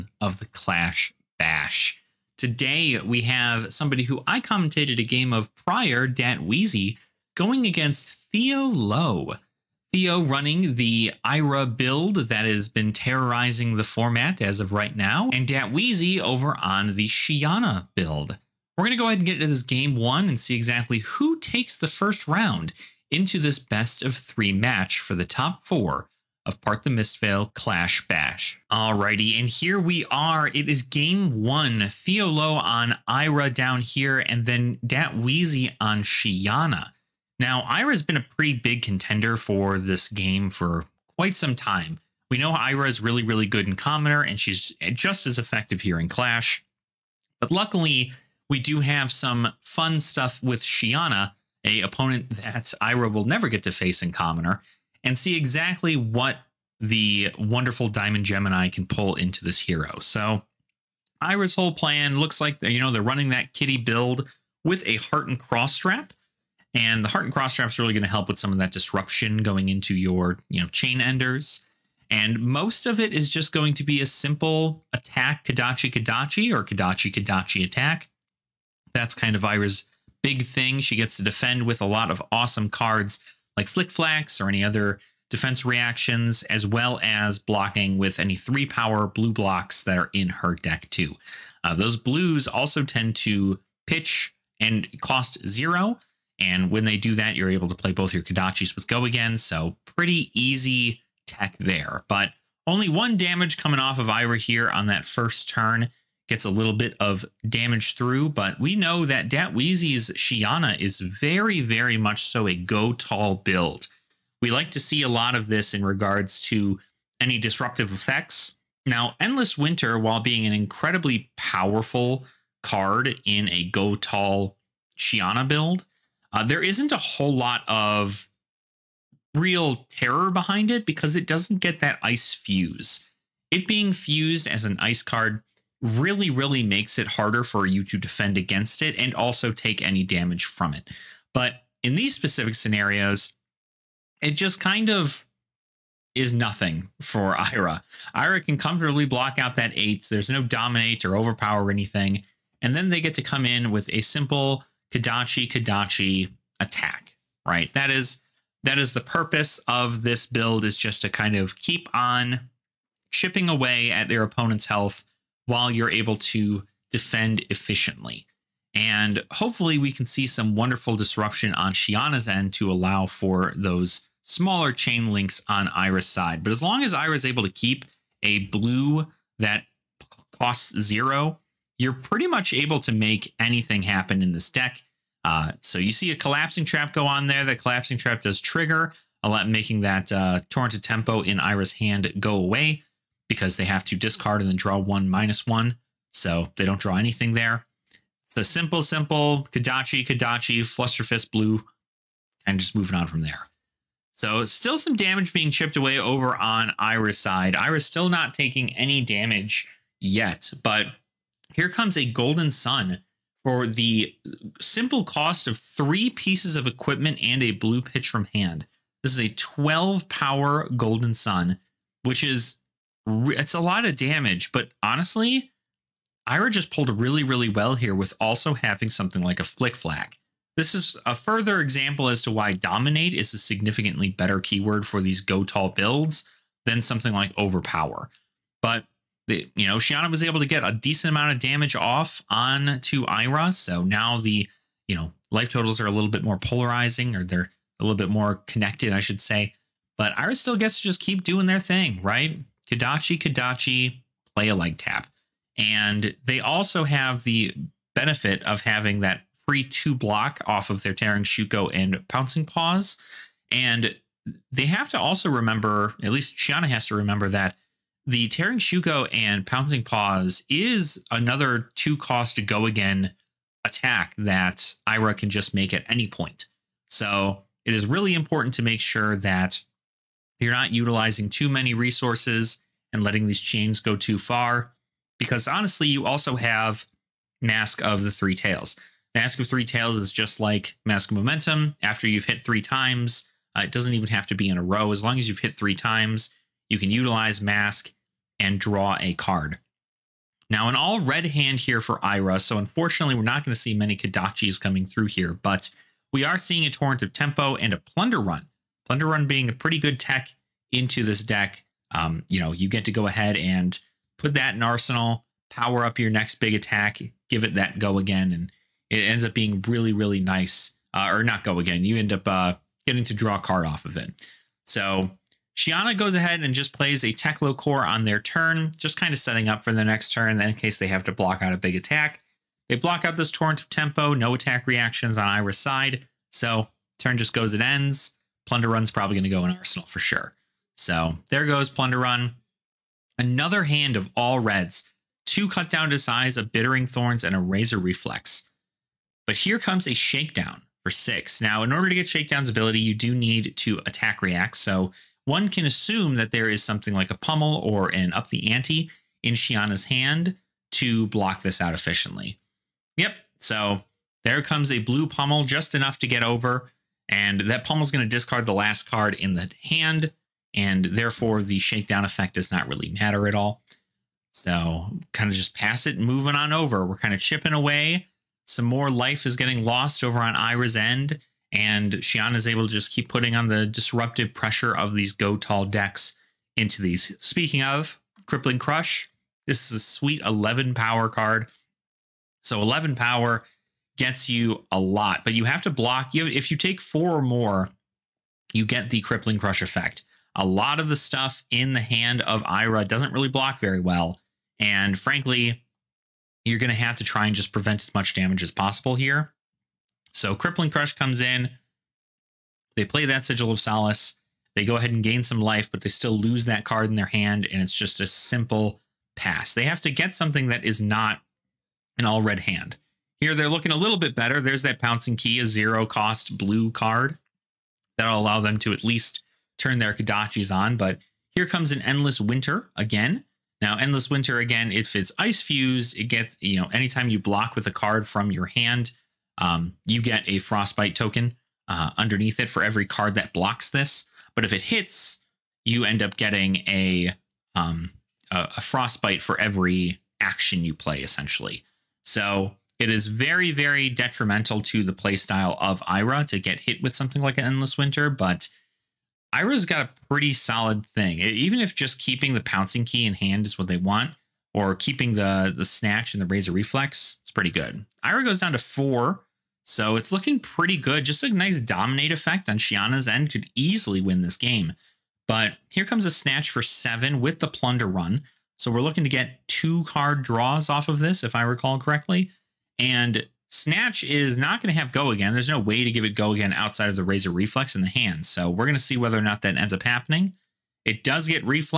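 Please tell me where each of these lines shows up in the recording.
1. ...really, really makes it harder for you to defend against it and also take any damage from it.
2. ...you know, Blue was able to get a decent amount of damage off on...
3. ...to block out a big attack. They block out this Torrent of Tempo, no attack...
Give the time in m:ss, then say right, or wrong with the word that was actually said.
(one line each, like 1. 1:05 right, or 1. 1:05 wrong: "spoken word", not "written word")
1. 2:15 right
2. 3:59 wrong: "Shiyana", not "Blue"
3. 5:31 right.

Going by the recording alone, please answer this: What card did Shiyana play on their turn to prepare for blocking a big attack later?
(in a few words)
Teklo Core.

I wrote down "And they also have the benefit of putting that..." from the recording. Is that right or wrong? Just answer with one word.
wrong.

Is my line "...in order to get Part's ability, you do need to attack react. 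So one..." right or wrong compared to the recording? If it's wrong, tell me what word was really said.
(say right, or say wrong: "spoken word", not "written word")
wrong: "Shakedown", not "Part".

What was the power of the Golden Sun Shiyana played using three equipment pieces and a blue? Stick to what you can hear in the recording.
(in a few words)
12.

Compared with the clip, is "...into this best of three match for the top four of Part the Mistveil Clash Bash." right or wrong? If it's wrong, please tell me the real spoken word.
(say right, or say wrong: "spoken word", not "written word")
right.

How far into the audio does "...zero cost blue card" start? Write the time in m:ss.
7:05.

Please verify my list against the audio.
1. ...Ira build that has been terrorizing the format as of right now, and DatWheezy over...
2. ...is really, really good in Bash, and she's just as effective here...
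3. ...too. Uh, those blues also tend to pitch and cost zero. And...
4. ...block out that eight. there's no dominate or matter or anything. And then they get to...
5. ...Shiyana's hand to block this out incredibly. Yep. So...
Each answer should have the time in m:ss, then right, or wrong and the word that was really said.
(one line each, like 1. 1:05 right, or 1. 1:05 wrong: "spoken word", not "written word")
1. 0:11 right
2. 0:42 wrong: "Commoner", not "Bash"
3. 1:30 right
4. 2:29 wrong: "overpower", not "matter"
5. 5:59 wrong: "efficiently", not "incredibly".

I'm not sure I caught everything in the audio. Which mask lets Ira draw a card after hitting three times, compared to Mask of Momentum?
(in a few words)
Mask of the Three Tails.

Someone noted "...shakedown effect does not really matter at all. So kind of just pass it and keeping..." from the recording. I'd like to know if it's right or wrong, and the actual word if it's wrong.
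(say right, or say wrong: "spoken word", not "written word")
wrong: "moving", not "keeping".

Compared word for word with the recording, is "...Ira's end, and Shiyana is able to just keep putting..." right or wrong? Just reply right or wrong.
right.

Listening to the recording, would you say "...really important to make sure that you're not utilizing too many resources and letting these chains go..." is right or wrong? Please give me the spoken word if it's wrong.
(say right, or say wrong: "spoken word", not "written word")
right.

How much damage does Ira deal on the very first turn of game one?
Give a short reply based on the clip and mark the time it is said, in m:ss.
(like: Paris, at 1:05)
1, at 1:42.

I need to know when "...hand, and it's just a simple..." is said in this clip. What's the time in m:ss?
6:57.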